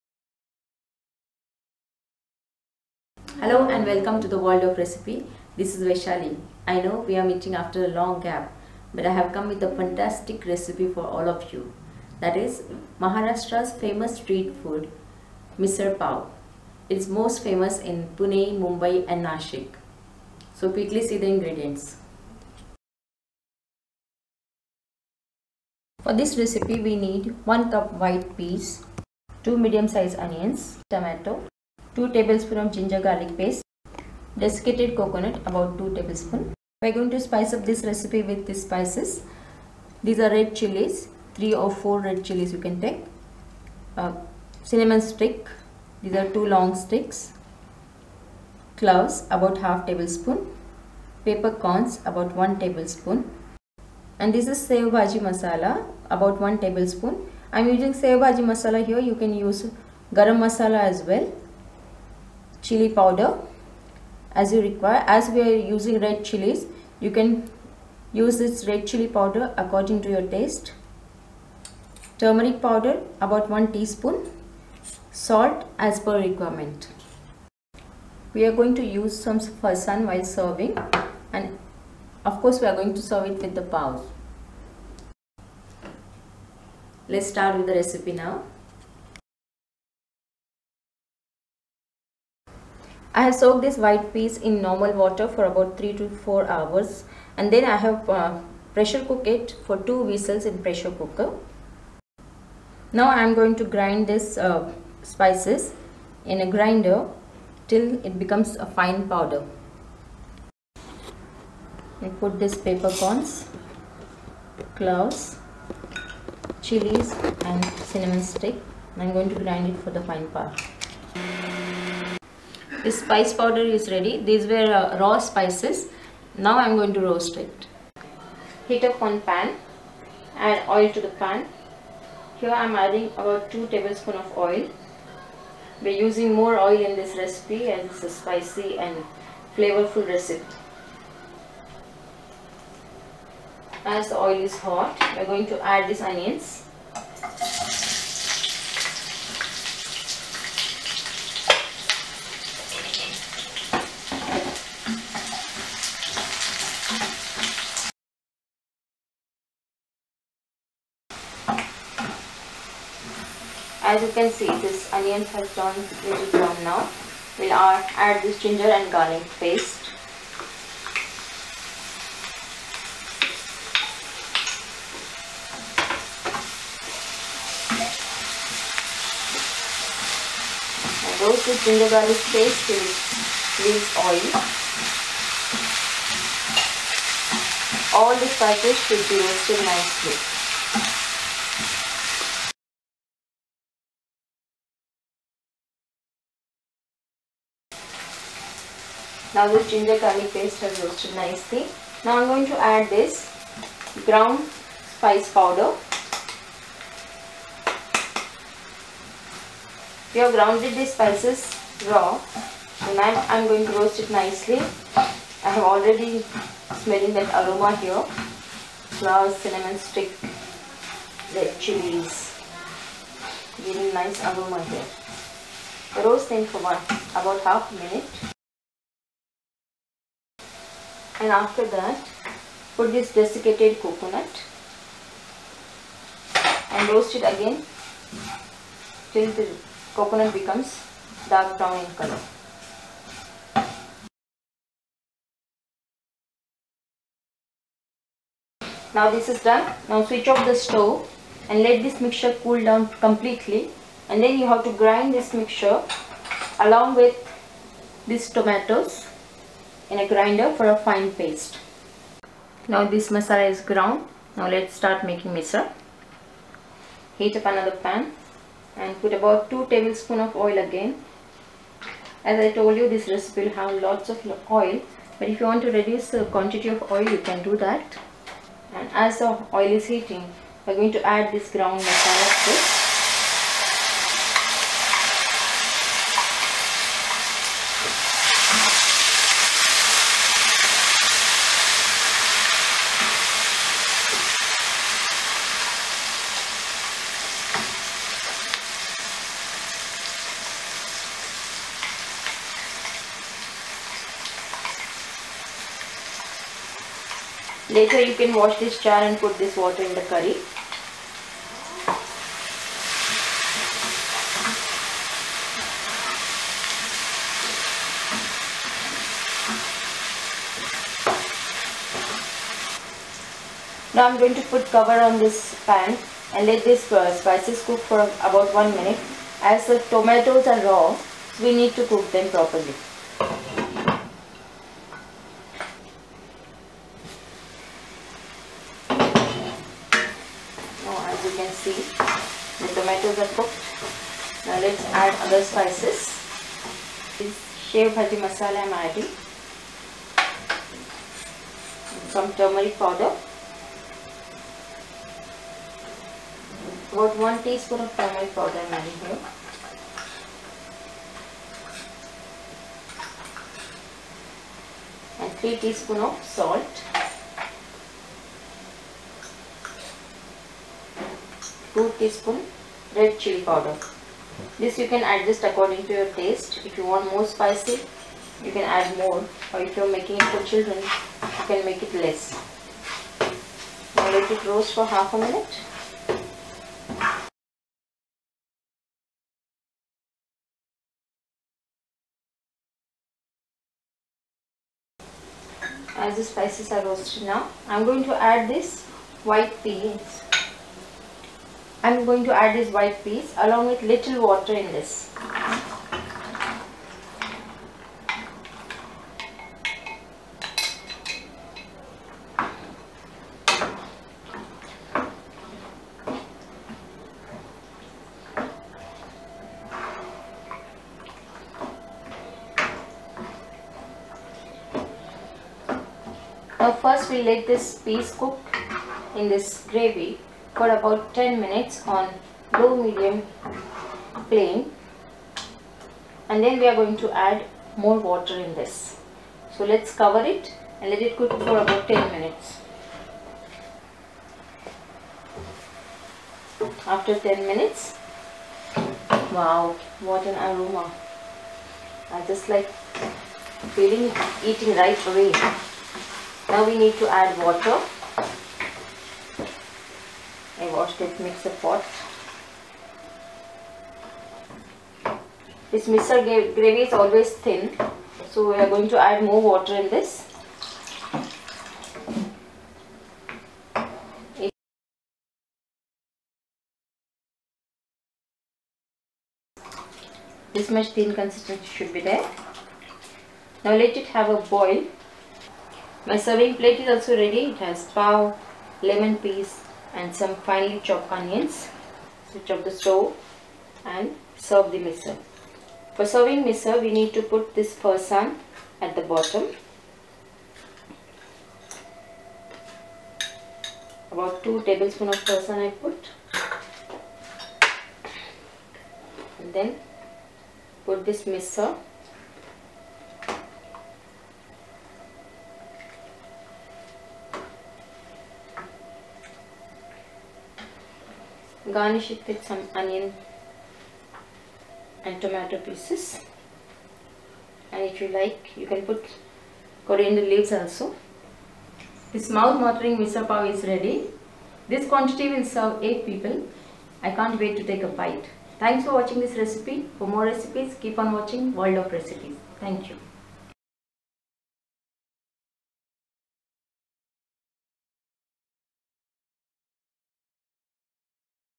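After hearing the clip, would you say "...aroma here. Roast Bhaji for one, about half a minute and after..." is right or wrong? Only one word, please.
wrong.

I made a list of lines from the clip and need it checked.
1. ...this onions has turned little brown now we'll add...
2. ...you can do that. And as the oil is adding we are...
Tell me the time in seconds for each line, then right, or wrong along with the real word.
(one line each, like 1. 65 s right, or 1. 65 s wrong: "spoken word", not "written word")
1. 164 s right
2. 277 s wrong: "heating", not "adding".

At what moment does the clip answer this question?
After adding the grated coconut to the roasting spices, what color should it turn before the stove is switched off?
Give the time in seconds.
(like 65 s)
241 s.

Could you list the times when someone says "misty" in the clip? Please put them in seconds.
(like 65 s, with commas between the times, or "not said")
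not said.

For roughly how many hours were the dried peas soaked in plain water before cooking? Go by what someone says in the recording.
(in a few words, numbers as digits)
3 to 4 hours.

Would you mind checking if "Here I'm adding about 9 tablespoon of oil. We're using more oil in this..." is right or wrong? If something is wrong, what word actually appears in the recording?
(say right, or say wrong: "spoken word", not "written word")
wrong: "2", not "9".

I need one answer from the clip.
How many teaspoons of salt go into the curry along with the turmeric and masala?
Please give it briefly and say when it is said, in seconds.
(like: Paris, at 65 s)
3, at 365 s.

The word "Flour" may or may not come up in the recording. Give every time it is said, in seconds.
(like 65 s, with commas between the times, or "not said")
219 s.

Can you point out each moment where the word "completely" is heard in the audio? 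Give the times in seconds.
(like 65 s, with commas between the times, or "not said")
252 s.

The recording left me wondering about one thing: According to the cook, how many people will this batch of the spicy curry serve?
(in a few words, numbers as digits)
8.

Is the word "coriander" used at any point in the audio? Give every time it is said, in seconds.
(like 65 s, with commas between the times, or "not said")
529 s.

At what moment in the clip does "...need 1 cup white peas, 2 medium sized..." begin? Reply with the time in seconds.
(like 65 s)
26 s.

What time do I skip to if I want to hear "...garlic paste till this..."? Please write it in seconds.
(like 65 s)
181 s.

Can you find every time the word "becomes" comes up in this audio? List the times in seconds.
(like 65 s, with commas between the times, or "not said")
108 s, 240 s.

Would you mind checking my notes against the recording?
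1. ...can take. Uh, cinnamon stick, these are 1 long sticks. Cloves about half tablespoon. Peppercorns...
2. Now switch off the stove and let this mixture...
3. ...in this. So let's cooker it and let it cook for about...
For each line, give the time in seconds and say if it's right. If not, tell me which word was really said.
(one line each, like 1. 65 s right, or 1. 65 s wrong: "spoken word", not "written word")
1. 42 s wrong: "2", not "1"
2. 249 s right
3. 438 s wrong: "cover", not "cooker".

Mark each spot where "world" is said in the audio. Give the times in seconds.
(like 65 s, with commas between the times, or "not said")
4 s, 541 s.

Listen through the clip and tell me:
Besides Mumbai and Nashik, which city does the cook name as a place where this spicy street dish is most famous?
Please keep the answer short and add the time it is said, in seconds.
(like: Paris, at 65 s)
Pune, at 18 s.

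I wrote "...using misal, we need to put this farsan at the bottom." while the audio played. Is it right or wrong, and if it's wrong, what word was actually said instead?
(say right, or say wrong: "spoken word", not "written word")
wrong: "serving", not "using".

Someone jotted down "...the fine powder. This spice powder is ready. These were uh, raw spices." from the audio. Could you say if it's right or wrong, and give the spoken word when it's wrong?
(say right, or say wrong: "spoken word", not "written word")
right.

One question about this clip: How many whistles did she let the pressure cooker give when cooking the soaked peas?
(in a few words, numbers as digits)
2.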